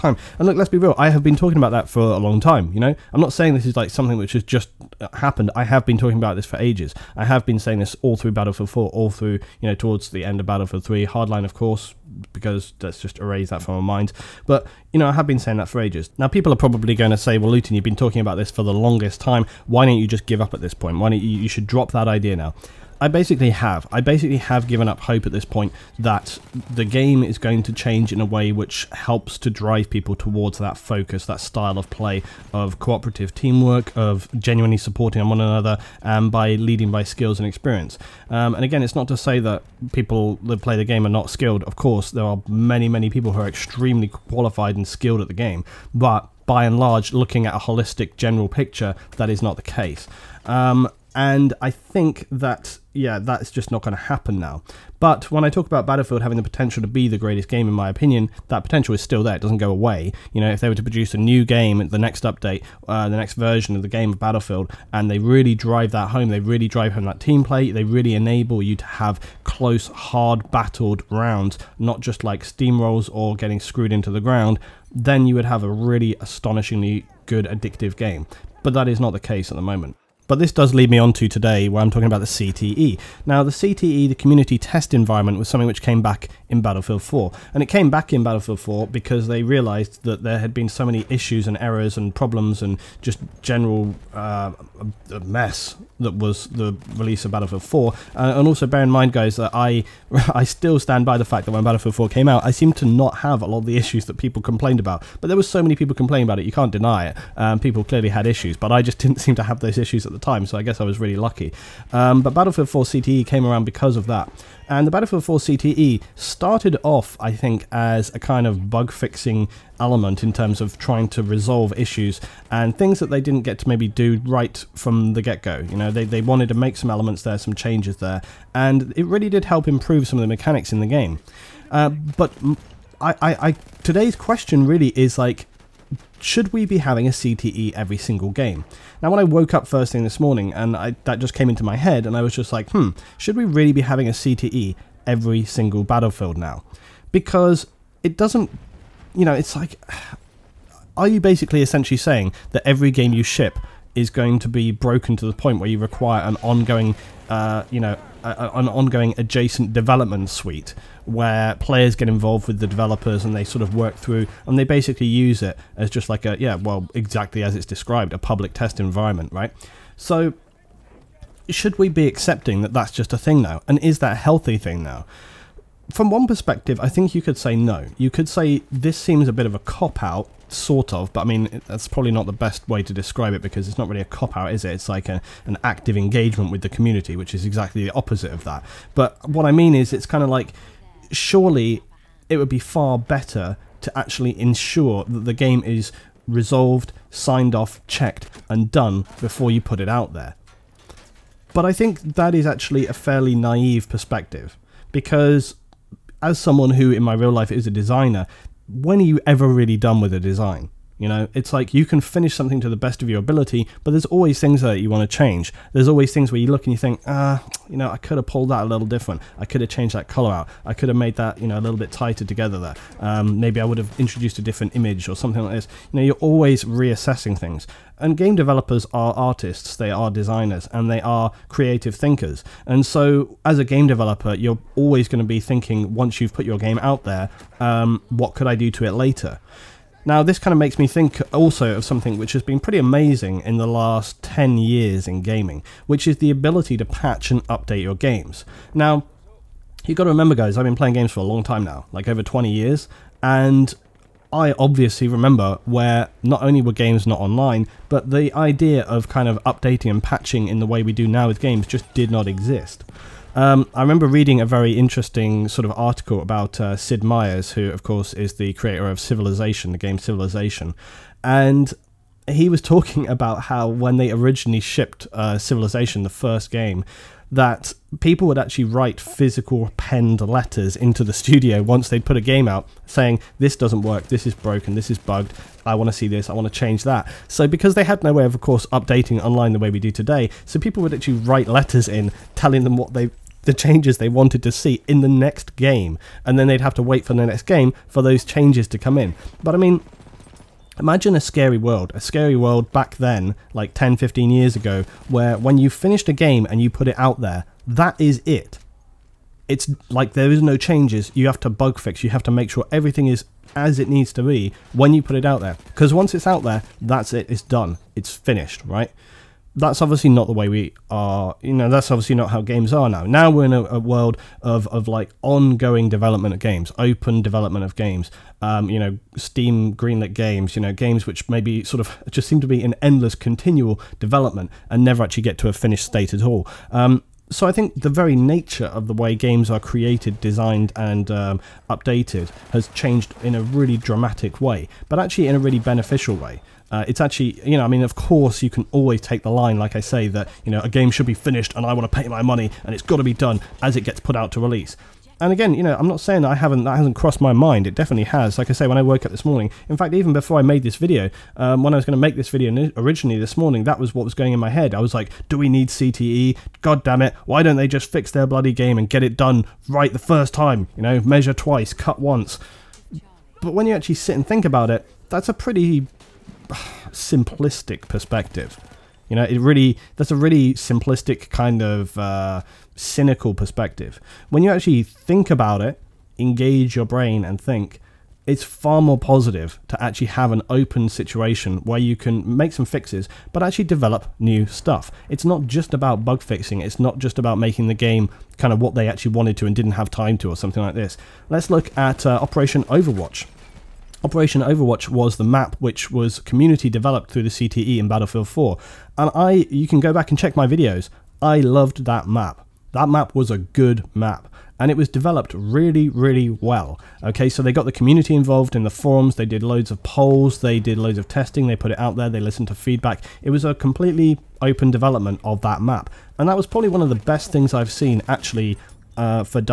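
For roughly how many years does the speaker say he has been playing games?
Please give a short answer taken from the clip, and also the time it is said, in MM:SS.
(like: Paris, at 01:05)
Over 20 years, at 04:12.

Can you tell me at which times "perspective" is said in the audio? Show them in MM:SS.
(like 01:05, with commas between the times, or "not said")
02:56, 03:23, 06:17, 06:23.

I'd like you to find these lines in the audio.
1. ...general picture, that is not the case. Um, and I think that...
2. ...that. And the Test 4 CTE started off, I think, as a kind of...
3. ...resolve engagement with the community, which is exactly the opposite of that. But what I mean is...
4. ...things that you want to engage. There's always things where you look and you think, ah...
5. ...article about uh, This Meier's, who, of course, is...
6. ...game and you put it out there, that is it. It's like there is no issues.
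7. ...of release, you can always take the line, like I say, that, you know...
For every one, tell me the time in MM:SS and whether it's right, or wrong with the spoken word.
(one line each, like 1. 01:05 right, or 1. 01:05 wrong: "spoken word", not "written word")
1. 00:48 right
2. 01:54 wrong: "Battlefield", not "Test"
3. 03:05 wrong: "active", not "resolve"
4. 03:34 wrong: "change", not "engage"
5. 04:25 wrong: "Sid", not "This"
6. 05:06 wrong: "changes", not "issues"
7. 05:47 wrong: "course", not "release".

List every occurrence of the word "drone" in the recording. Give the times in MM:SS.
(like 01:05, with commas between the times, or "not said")
not said.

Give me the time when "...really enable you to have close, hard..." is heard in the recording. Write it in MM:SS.
01:07.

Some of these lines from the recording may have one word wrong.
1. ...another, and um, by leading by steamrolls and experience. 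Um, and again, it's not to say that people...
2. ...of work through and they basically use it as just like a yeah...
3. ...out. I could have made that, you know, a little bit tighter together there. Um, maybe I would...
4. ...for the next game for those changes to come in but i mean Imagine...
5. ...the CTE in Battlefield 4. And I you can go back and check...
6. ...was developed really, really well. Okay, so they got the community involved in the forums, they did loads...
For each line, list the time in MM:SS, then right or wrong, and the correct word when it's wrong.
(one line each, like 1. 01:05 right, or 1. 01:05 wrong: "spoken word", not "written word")
1. 00:35 wrong: "skills", not "steamrolls"
2. 02:43 right
3. 03:40 right
4. 04:57 right
5. 06:47 right
6. 06:54 right.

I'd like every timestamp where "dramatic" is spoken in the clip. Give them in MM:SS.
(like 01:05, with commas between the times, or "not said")
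05:43.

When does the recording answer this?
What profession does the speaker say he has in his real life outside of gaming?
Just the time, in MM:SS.
03:27.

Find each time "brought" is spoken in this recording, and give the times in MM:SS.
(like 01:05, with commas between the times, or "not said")
not said.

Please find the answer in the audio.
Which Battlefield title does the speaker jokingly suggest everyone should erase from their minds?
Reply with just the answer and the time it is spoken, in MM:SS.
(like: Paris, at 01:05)
Hardline, at 00:11.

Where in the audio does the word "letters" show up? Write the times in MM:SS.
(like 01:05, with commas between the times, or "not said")
04:40, 04:51.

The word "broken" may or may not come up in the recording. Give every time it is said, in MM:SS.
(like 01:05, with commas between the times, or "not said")
02:34, 04:44.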